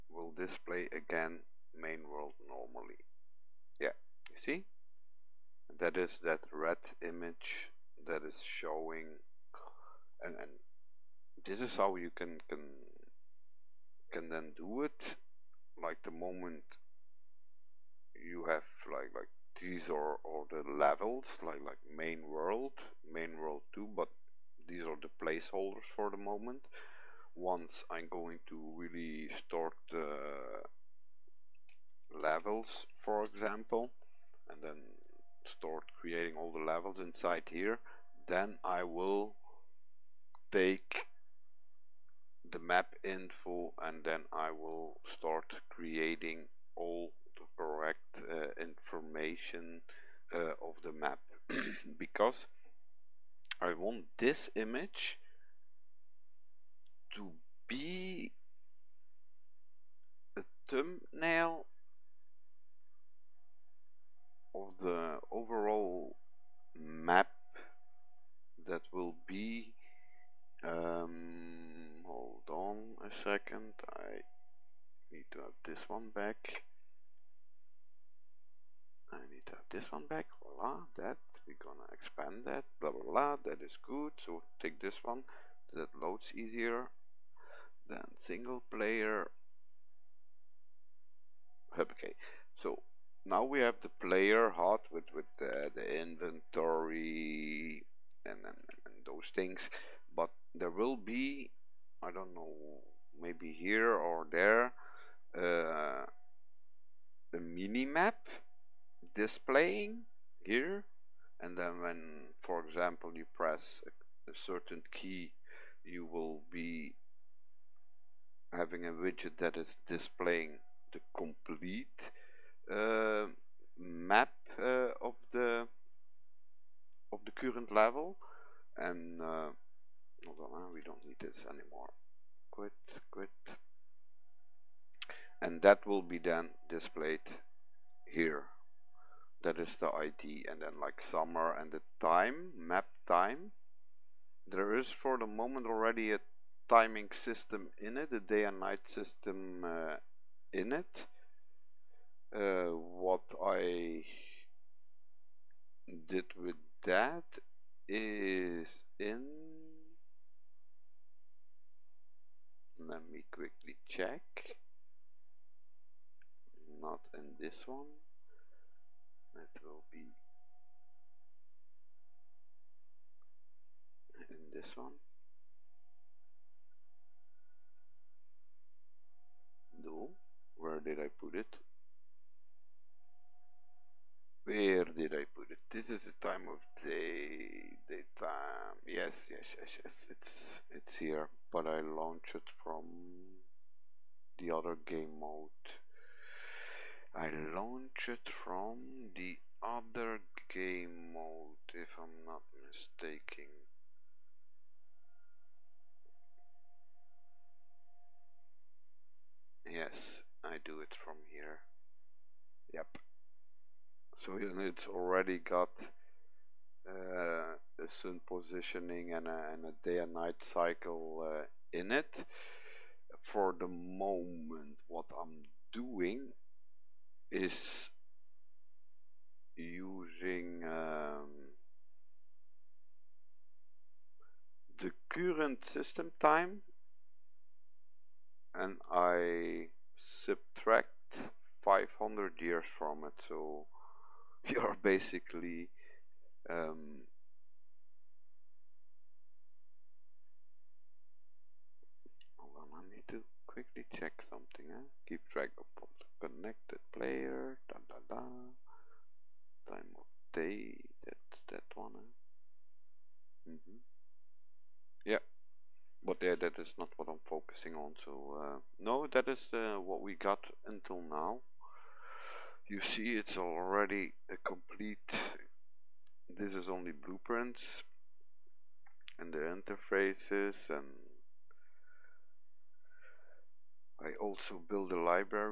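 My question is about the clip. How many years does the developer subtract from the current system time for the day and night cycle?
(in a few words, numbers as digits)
500.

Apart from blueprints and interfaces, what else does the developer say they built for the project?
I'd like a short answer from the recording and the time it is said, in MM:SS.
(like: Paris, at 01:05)
a library, at 04:44.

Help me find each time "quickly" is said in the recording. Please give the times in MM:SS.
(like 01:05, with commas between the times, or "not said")
02:43, 04:13.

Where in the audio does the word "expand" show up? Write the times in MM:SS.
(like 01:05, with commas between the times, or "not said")
01:21.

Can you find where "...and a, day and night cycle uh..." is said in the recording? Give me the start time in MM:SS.
03:39.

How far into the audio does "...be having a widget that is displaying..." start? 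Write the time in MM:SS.
01:56.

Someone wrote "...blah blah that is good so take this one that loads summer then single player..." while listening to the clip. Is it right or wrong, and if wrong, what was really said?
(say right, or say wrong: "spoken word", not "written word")
wrong: "easier", not "summer".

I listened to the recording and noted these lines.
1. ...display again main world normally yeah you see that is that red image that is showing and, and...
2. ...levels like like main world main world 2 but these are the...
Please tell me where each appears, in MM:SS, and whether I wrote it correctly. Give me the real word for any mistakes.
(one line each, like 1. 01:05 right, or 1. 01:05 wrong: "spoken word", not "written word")
1. 00:00 right
2. 00:20 right.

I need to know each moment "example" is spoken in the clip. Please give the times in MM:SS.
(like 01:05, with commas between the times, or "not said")
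00:33, 01:52.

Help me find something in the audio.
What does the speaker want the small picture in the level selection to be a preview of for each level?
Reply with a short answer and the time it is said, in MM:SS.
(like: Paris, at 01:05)
the overall map, at 01:04.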